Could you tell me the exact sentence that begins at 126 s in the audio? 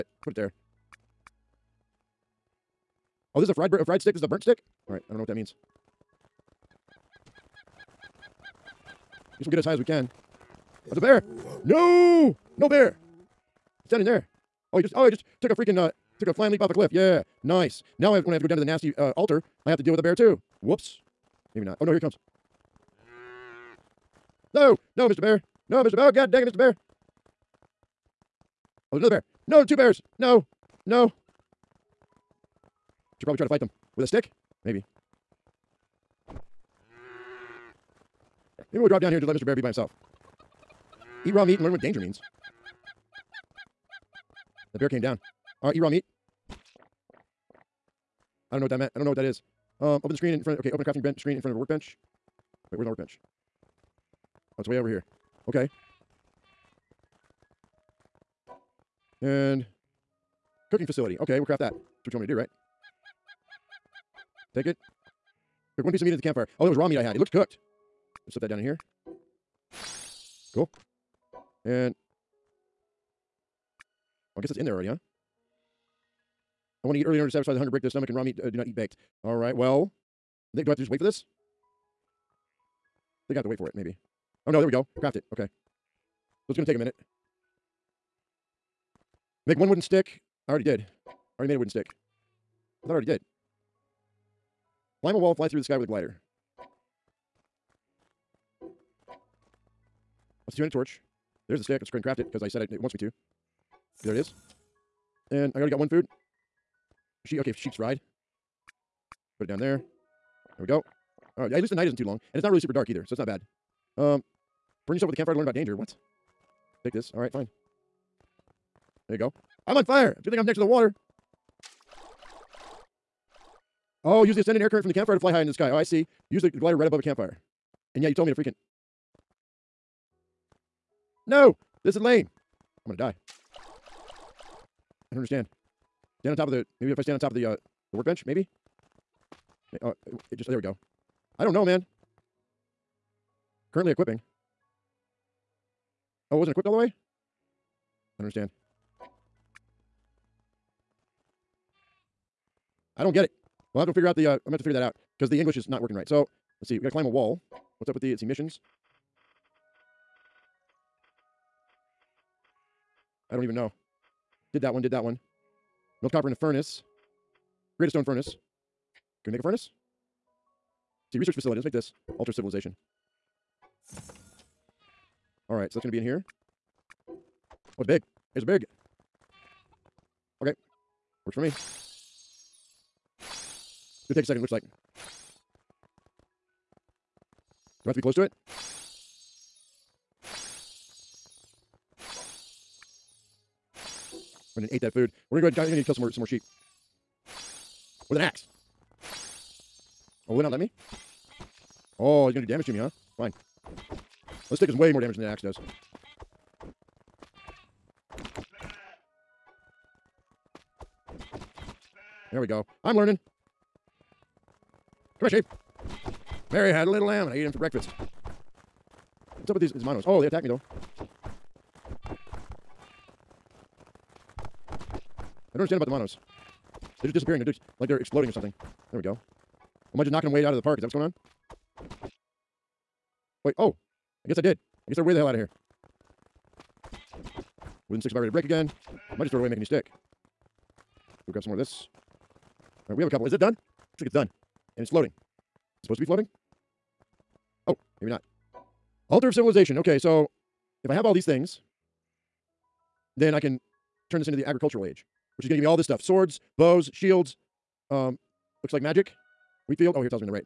Use the glider right above a campfire.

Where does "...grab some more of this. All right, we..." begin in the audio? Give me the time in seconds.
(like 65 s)
241 s.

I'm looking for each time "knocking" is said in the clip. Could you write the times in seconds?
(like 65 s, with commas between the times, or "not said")
230 s.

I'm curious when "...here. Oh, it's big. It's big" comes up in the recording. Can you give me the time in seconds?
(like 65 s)
176 s.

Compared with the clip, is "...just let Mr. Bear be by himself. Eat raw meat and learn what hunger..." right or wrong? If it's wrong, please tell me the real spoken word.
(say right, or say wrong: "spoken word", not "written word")
wrong: "danger", not "hunger".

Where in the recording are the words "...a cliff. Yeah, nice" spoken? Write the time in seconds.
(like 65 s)
16 s.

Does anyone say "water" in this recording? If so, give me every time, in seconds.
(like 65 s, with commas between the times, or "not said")
120 s.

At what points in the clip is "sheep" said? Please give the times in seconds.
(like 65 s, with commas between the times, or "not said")
107 s, 196 s, 215 s.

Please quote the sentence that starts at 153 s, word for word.
Well, I have to figure out the.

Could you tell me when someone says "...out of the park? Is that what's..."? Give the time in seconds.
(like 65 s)
230 s.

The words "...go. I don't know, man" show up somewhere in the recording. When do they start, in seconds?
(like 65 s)
140 s.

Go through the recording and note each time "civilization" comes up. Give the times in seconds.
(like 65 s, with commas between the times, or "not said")
172 s, 249 s.